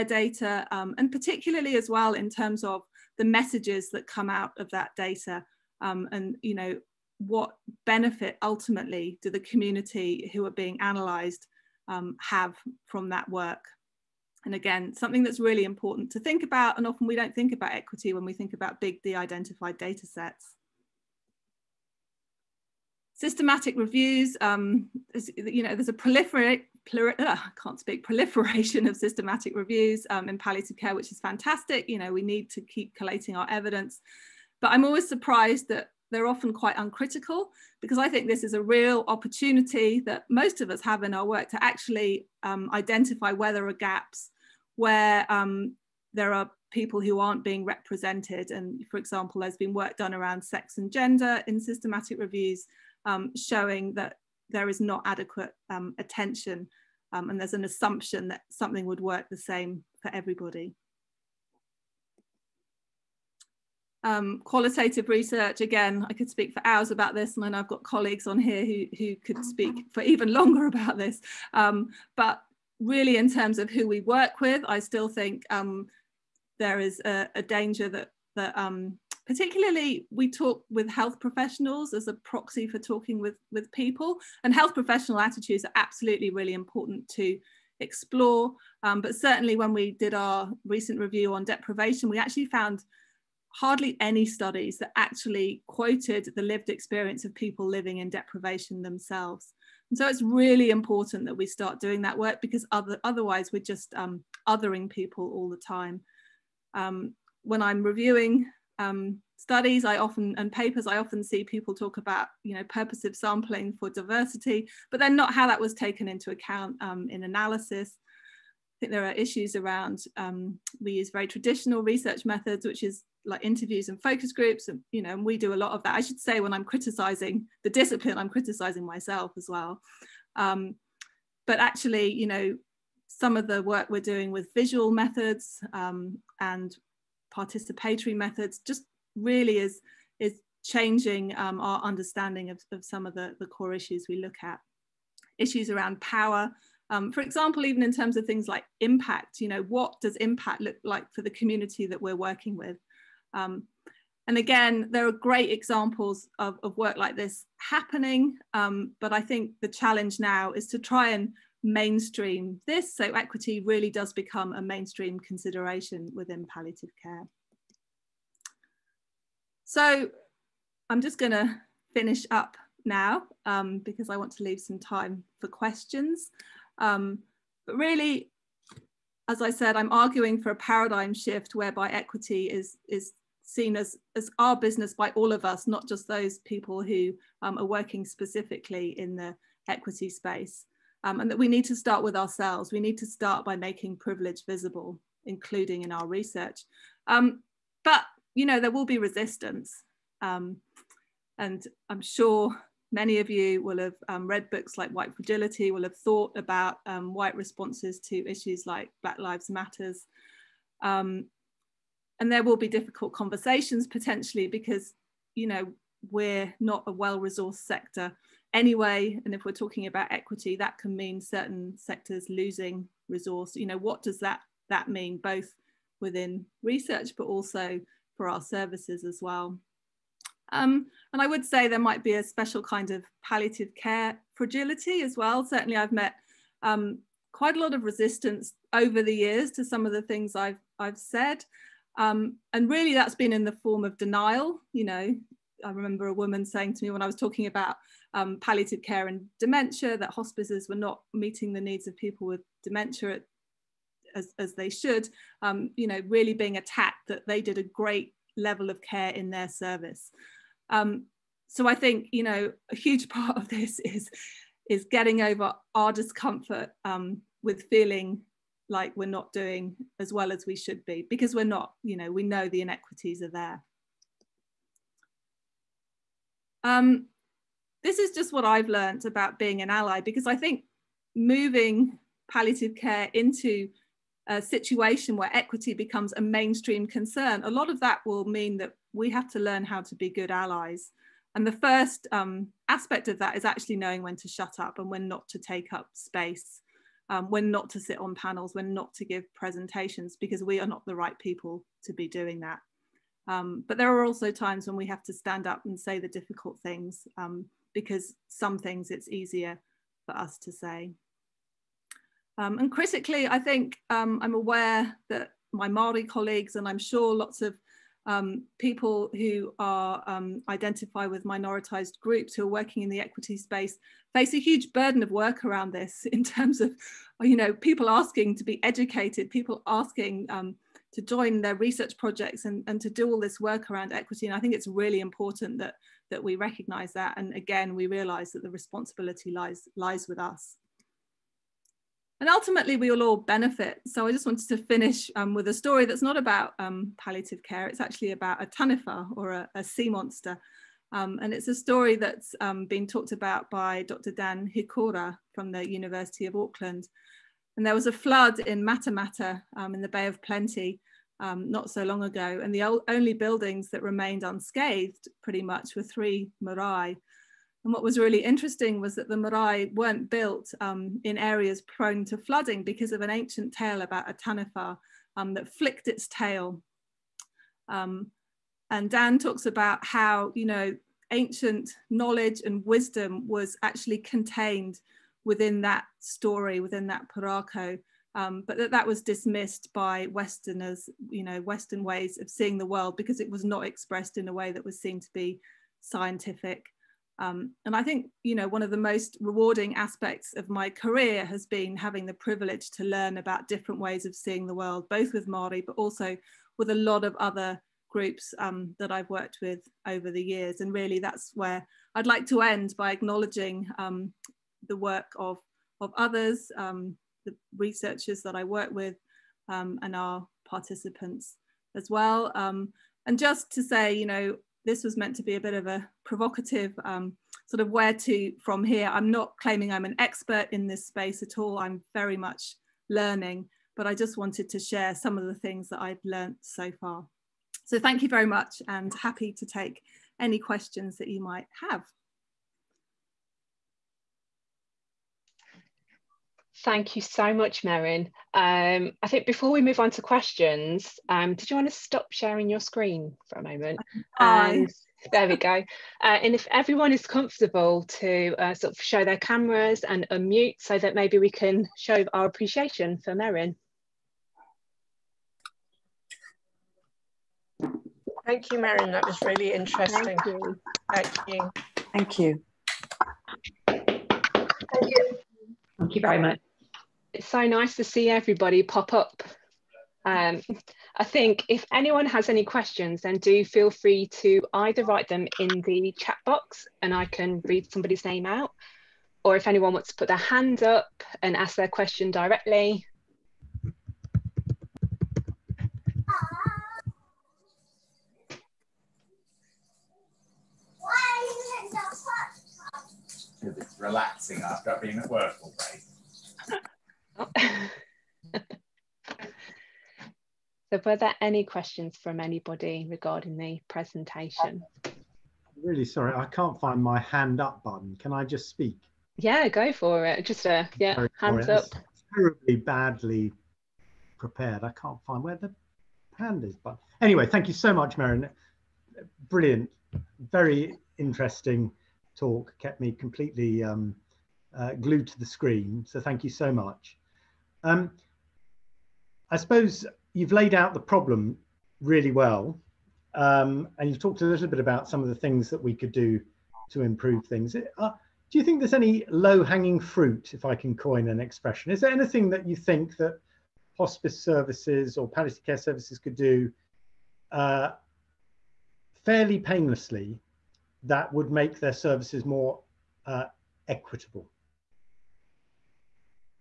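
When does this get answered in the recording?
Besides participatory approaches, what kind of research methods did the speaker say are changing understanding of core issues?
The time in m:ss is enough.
2:14.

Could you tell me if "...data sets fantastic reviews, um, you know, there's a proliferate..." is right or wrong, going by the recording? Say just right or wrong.
wrong.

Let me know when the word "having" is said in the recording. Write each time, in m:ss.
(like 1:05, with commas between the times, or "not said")
6:41.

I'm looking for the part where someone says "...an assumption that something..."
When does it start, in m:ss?
0:57.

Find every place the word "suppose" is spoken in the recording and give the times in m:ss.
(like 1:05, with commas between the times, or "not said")
8:59.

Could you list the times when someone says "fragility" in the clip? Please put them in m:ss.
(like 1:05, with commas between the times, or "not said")
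3:25, 3:54.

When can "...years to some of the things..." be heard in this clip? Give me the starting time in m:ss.
3:59.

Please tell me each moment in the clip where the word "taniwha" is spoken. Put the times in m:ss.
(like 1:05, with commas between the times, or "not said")
5:48, 6:14.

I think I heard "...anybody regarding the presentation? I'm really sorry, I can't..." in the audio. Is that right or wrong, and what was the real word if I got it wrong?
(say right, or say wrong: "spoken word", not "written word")
right.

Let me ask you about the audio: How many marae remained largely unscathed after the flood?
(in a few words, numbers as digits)
3.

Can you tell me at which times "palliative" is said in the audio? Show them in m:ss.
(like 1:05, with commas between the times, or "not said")
0:30, 2:46, 3:53, 4:08, 4:42, 5:46, 9:15.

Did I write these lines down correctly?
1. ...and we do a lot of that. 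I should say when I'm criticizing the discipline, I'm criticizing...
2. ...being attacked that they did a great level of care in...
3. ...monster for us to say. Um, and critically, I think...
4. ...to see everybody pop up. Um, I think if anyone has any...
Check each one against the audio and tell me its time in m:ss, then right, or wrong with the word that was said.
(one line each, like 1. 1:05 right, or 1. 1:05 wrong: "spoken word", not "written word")
1. 2:05 right
2. 4:16 right
3. 5:09 wrong: "easier", not "monster"
4. 7:57 right.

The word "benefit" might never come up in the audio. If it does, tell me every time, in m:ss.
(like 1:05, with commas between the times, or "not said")
0:07, 5:43.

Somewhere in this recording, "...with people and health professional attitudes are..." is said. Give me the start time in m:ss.
1:23.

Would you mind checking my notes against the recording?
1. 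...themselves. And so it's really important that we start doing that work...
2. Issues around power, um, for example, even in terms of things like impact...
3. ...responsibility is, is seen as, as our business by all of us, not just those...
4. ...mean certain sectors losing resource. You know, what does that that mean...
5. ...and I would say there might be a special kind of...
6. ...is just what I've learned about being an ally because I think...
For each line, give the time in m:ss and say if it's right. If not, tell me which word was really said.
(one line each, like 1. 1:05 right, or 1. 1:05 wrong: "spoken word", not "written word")
1. 1:38 right
2. 2:25 right
3. 3:01 wrong: "equity", not "responsibility"
4. 3:40 right
5. 3:51 right
6. 4:37 right.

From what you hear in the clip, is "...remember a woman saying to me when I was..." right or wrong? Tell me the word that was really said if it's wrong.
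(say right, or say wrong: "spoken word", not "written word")
right.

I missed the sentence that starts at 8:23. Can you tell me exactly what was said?
It's relaxing after being at work all day.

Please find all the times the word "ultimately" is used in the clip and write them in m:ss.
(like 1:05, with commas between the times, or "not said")
0:08, 5:42.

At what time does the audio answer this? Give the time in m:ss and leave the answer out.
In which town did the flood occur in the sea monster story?
5:58.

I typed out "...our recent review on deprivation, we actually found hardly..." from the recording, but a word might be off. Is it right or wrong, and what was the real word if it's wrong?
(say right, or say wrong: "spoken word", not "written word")
right.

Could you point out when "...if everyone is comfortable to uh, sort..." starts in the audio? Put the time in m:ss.
7:36.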